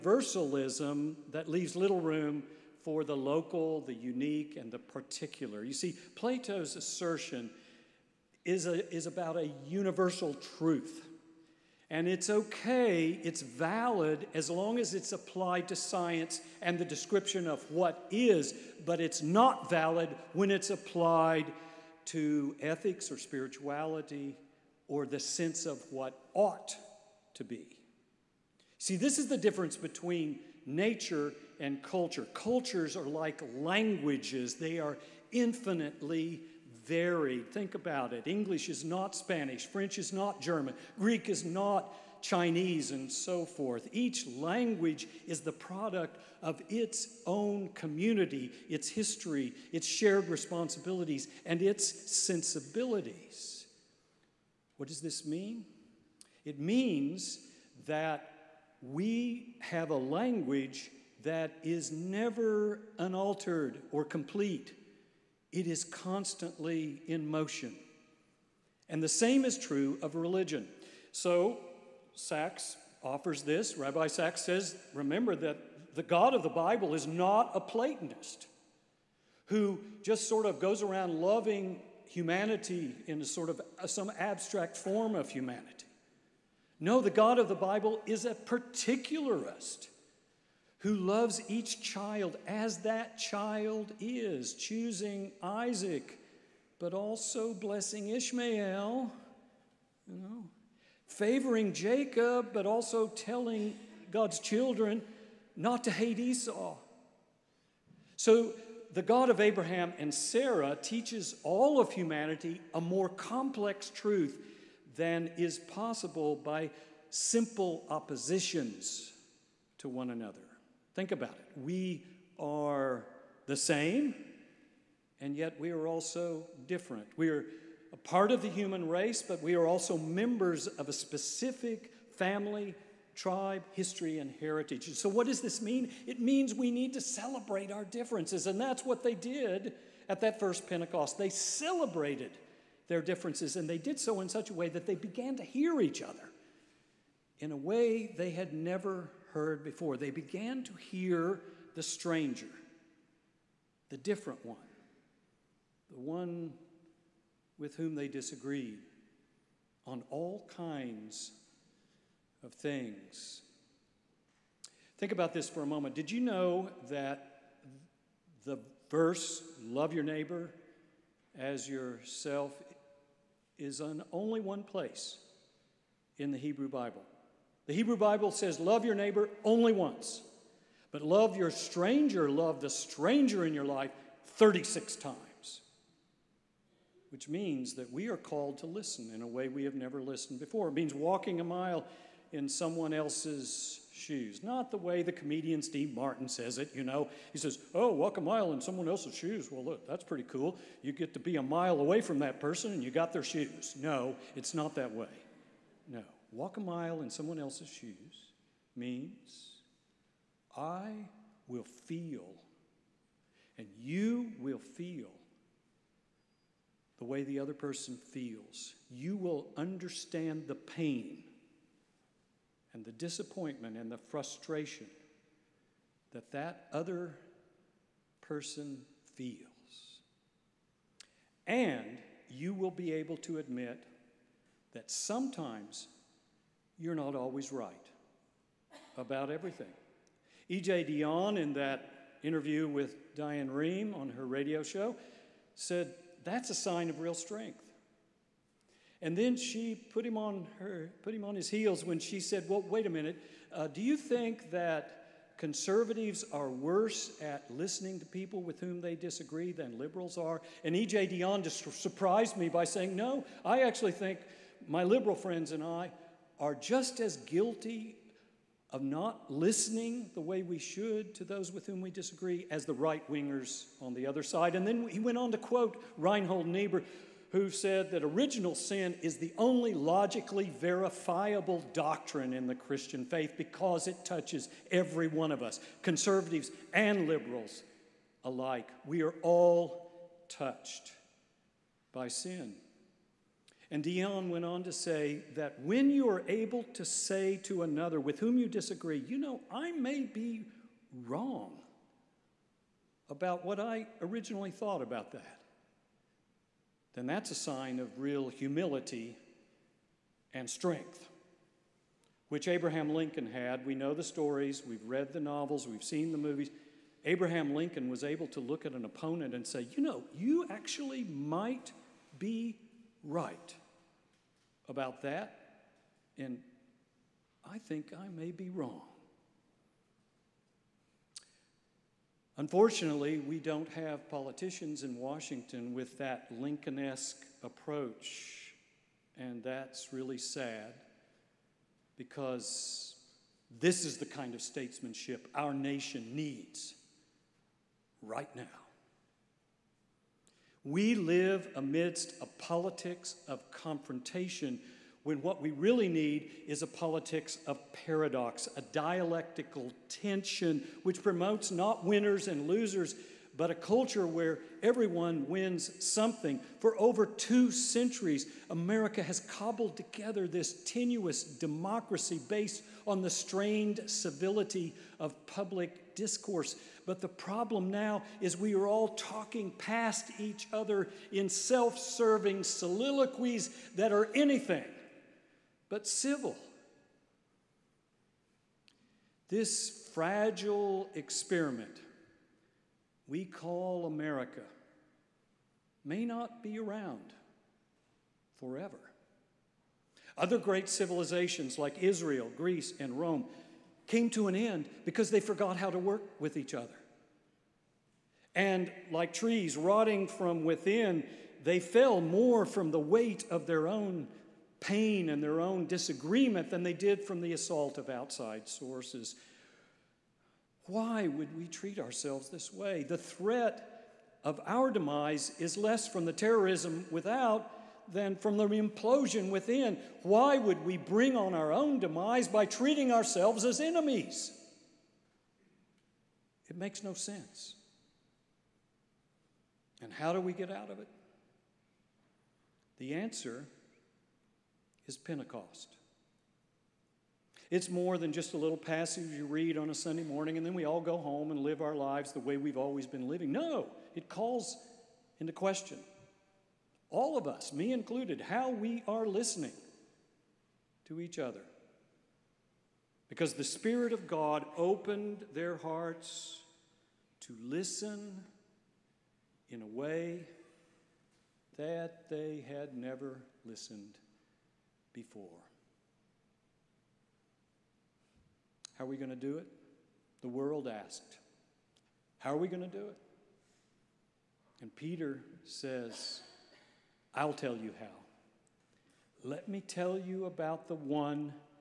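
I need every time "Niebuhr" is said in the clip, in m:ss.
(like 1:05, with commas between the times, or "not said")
4:36.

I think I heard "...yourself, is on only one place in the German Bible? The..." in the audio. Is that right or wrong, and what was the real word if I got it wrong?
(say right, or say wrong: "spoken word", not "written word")
wrong: "Hebrew", not "German".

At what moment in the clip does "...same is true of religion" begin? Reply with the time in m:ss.
1:09.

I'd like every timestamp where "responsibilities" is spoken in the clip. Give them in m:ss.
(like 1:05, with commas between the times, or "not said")
0:50.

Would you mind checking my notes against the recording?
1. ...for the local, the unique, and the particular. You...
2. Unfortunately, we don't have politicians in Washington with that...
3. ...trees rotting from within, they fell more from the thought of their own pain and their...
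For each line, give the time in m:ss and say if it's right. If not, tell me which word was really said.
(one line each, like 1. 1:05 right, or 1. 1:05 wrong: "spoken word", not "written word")
1. 0:02 right
2. 5:32 right
3. 6:49 wrong: "weight", not "thought".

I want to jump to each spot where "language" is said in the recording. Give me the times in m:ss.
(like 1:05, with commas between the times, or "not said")
0:33, 0:44, 0:59.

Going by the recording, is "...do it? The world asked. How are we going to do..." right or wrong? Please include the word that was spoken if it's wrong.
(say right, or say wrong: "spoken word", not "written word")
right.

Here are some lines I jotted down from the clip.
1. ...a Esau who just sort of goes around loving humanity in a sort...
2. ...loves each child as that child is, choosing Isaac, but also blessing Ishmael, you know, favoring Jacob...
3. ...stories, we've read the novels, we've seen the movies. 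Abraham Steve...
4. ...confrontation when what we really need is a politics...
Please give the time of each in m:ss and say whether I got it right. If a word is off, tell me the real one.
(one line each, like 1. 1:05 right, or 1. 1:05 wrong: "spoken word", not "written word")
1. 1:17 wrong: "Platonist", not "Esau"
2. 1:30 right
3. 5:14 wrong: "Lincoln", not "Steve"
4. 5:53 right.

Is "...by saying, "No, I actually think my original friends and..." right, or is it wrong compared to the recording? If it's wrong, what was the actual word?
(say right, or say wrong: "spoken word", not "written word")
wrong: "liberal", not "original".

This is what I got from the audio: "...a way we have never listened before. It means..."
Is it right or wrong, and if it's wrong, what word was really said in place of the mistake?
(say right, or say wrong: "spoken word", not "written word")
right.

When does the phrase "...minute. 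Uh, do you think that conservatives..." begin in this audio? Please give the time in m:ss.
4:12.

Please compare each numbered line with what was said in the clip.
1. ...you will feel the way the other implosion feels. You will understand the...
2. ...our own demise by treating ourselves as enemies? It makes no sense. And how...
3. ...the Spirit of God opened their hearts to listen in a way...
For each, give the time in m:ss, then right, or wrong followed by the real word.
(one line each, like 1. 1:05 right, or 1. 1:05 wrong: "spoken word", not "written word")
1. 3:33 wrong: "person", not "implosion"
2. 7:11 right
3. 7:43 right.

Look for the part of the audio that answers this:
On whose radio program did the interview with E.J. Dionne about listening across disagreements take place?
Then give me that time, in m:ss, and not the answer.
4:03.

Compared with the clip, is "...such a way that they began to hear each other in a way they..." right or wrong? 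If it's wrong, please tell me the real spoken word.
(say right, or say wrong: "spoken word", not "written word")
right.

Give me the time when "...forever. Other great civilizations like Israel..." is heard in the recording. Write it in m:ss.
6:38.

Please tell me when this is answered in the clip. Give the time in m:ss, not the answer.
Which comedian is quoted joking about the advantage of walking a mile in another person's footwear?
3:15.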